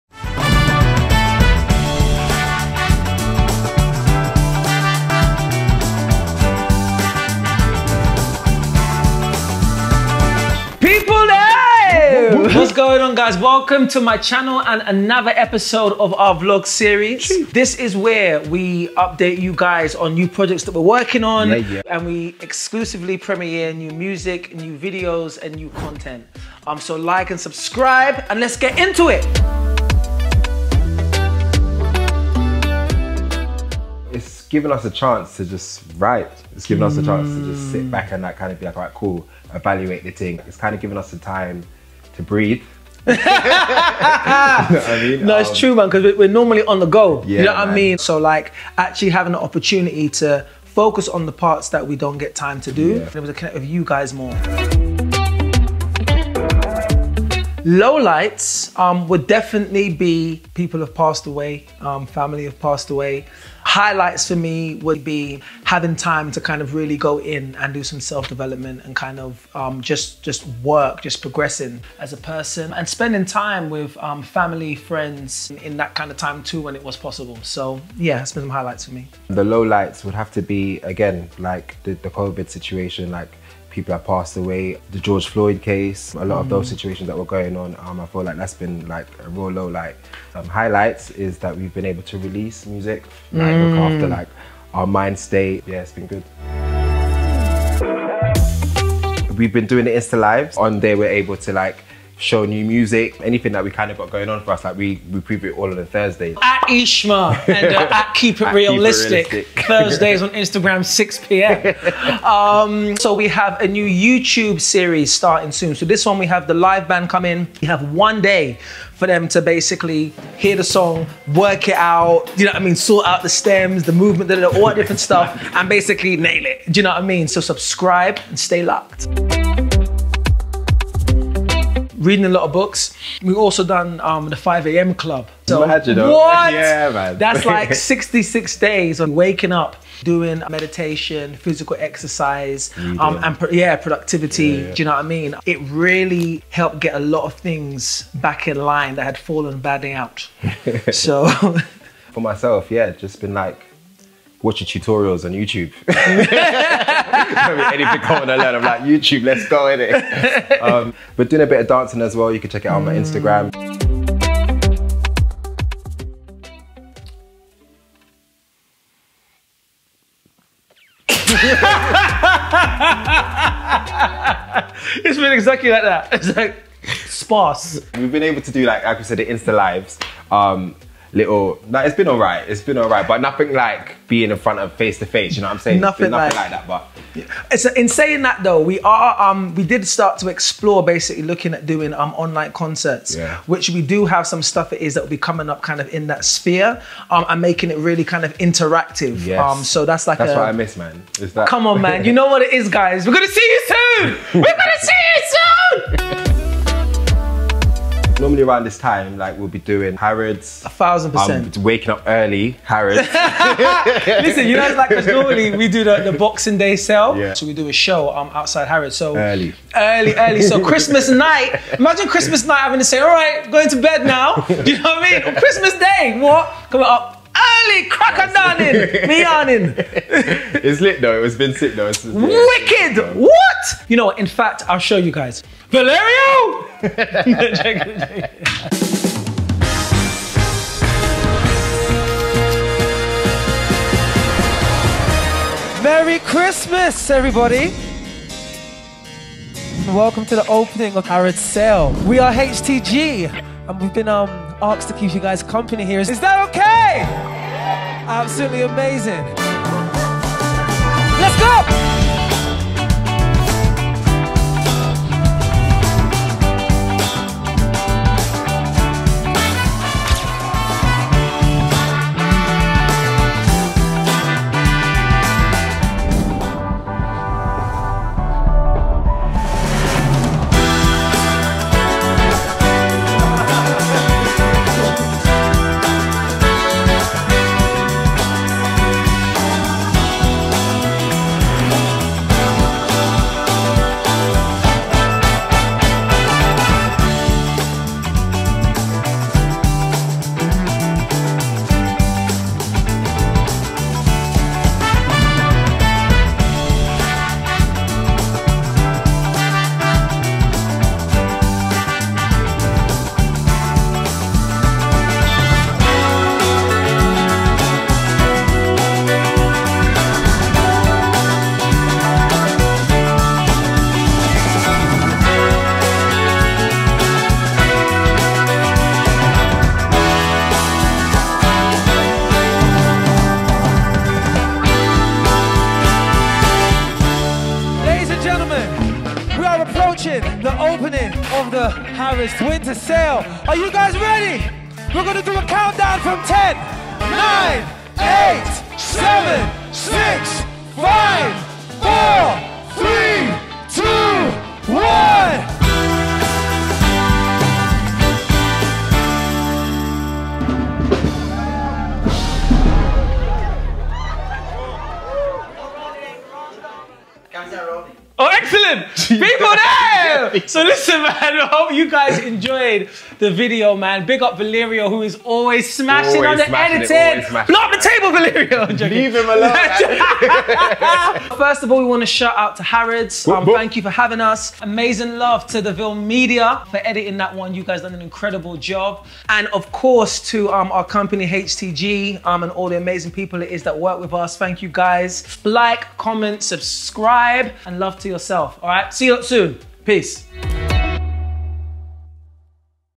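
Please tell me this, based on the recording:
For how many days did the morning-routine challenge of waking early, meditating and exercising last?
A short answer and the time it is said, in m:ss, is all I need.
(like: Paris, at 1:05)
66, at 2:17.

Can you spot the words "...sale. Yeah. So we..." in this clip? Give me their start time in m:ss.
3:36.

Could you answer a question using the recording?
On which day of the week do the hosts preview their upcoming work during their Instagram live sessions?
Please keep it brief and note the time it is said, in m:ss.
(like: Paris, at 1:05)
Thursday, at 1:45.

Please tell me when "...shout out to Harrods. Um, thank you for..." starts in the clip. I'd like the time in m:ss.
6:22.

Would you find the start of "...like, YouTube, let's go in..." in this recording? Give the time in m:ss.
2:38.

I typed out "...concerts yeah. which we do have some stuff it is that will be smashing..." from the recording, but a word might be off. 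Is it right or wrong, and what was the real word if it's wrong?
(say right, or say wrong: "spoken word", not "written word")
wrong: "coming", not "smashing".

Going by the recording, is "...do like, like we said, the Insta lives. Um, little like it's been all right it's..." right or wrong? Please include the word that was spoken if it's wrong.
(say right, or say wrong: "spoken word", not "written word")
right.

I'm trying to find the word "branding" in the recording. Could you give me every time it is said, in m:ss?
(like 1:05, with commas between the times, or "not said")
not said.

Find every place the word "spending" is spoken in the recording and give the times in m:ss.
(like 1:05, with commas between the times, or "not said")
1:12.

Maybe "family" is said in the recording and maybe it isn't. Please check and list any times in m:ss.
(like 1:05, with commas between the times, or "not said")
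1:02, 1:14.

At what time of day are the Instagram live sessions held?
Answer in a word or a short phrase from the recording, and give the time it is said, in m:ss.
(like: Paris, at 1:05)
6 p.m., at 1:50.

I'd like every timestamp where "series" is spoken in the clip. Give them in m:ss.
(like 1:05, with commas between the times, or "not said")
0:16, 1:54.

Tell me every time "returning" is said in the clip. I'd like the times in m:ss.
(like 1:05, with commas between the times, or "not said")
not said.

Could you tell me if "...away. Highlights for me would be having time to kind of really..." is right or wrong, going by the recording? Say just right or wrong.
right.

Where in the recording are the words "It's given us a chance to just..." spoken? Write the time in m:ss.
0:34.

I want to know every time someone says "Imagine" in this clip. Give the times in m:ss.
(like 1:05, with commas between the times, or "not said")
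2:15, 3:41.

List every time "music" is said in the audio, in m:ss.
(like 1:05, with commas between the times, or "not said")
0:23, 1:32, 1:42.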